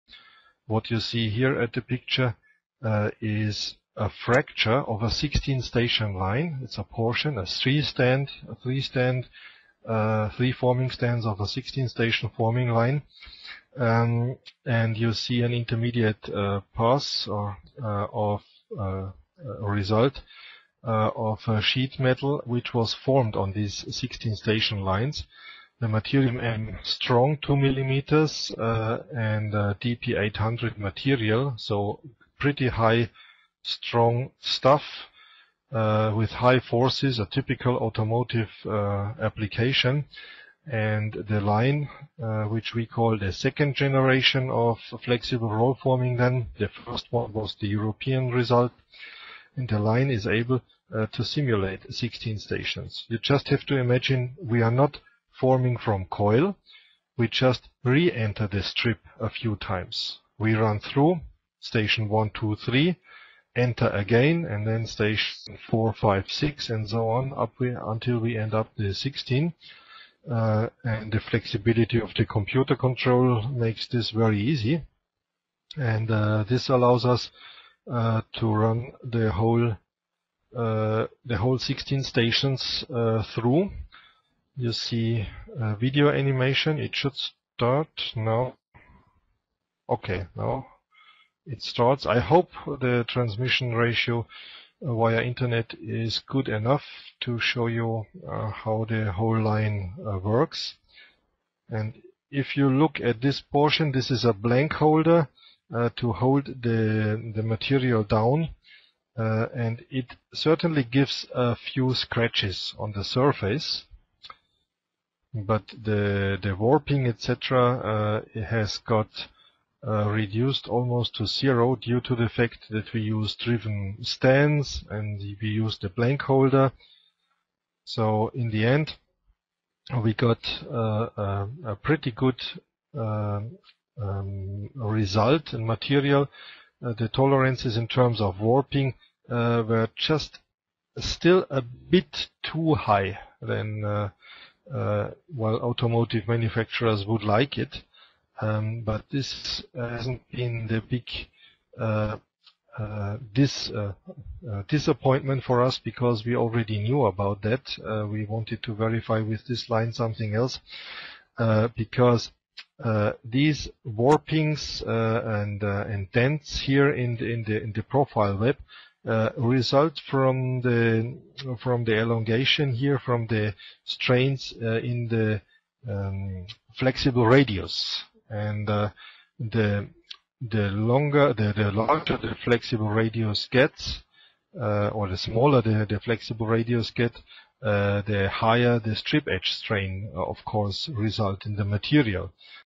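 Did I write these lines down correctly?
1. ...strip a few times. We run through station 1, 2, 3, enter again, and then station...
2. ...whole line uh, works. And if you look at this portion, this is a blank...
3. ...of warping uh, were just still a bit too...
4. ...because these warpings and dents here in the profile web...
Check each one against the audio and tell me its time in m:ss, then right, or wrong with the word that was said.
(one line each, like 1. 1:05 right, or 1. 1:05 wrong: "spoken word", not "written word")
1. 0:58 right
2. 1:39 right
3. 2:18 right
4. 2:41 right.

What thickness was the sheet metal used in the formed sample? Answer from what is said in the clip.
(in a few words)
2 millimeters.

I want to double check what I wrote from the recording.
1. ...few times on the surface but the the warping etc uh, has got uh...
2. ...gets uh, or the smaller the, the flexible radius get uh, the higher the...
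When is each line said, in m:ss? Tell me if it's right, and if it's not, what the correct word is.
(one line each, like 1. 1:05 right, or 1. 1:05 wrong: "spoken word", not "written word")
1. 1:51 wrong: "scratches", not "times"
2. 3:03 right.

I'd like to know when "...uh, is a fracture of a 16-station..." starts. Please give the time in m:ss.
0:02.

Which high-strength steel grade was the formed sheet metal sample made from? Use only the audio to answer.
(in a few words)
DP800.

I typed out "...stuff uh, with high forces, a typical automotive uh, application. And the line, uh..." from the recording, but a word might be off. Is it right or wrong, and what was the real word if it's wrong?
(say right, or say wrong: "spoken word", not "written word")
right.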